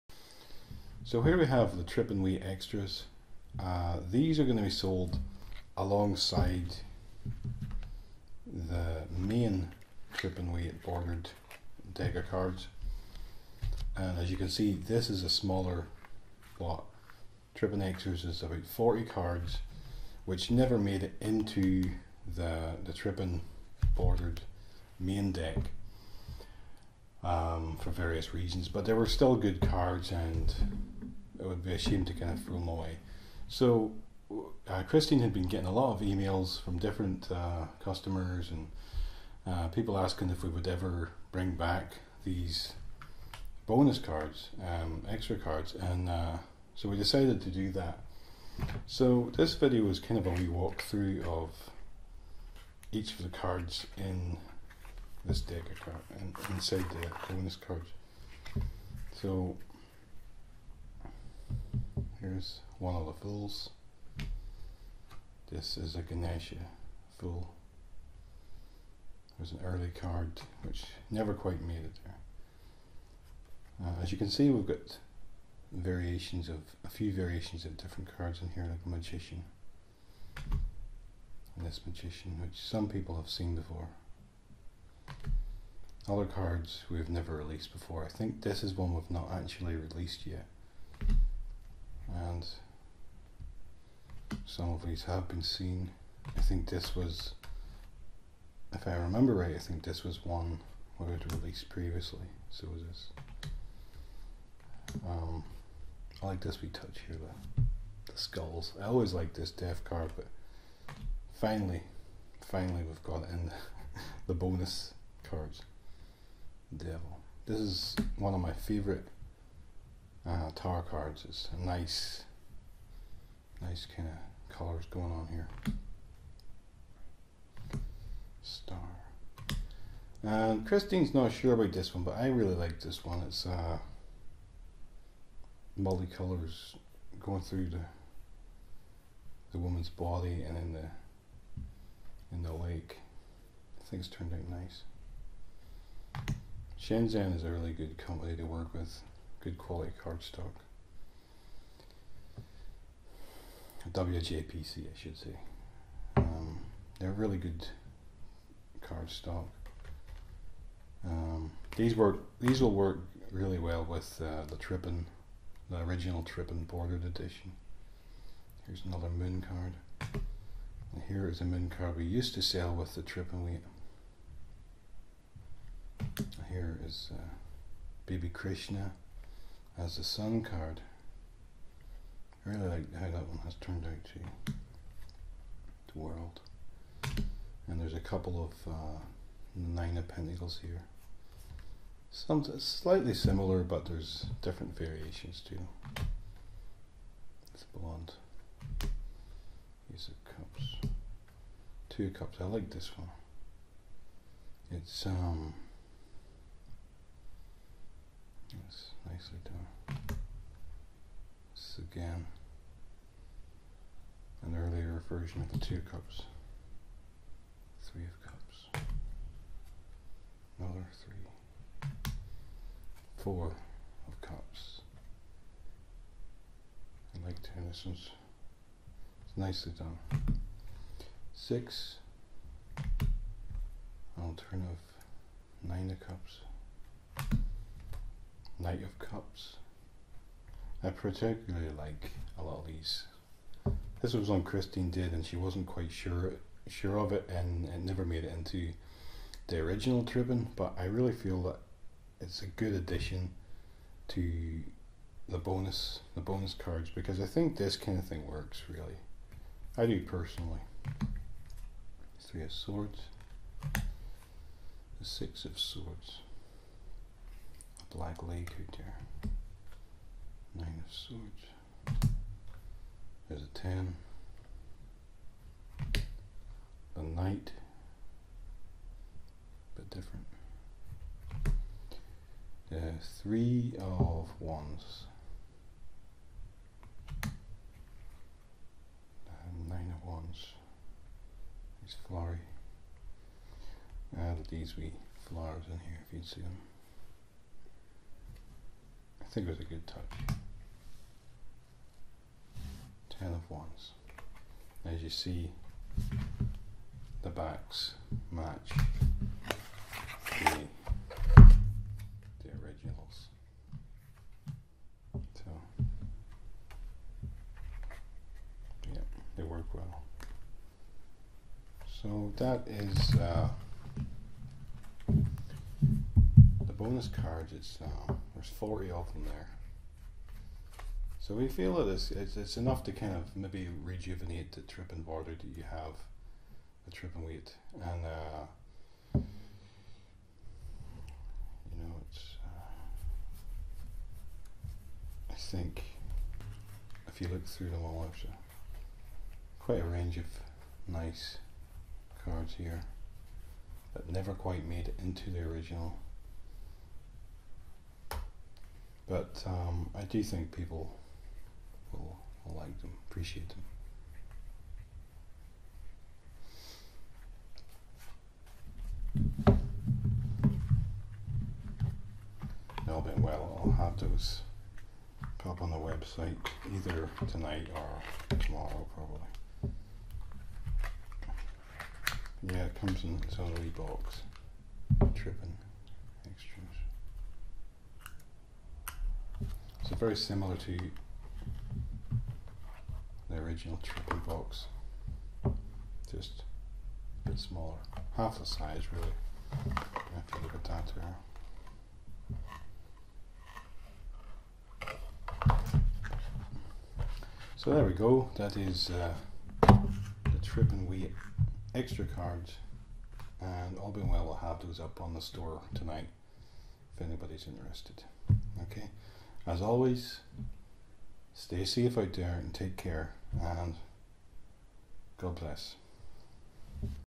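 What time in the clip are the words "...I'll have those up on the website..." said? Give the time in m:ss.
6:13.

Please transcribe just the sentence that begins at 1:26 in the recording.
Other cards we've never released before.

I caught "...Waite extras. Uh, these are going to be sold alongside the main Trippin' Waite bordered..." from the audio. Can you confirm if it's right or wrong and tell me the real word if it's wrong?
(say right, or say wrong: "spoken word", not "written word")
right.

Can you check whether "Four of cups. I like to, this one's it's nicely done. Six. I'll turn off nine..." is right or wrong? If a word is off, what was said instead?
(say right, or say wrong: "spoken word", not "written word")
right.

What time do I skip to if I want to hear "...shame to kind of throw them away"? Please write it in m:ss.
0:31.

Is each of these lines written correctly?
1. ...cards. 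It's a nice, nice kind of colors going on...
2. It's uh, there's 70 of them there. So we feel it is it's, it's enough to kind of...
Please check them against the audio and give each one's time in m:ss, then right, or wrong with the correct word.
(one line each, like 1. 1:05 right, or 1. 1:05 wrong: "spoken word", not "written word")
1. 2:00 right
2. 5:27 wrong: "40", not "70".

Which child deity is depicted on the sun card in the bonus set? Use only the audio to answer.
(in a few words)
Baby Krishna.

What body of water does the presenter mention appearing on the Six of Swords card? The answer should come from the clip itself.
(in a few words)
Black Lake.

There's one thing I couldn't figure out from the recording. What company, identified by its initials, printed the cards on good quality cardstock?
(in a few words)
WJPC.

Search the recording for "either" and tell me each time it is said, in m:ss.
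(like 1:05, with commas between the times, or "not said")
6:16.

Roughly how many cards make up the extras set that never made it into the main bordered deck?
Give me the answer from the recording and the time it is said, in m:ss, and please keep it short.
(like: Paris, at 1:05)
40, at 0:18.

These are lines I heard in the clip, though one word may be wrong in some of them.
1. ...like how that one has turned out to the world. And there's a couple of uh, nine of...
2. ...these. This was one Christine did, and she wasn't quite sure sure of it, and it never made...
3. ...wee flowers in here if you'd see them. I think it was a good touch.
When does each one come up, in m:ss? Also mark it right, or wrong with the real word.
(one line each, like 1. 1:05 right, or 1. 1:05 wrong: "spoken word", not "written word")
1. 3:02 right
2. 4:02 right
3. 4:54 right.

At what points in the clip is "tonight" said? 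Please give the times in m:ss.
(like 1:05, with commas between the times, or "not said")
6:17, 6:55.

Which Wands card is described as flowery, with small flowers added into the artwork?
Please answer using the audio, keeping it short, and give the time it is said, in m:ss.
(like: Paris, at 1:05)
Nine of Wands, at 4:49.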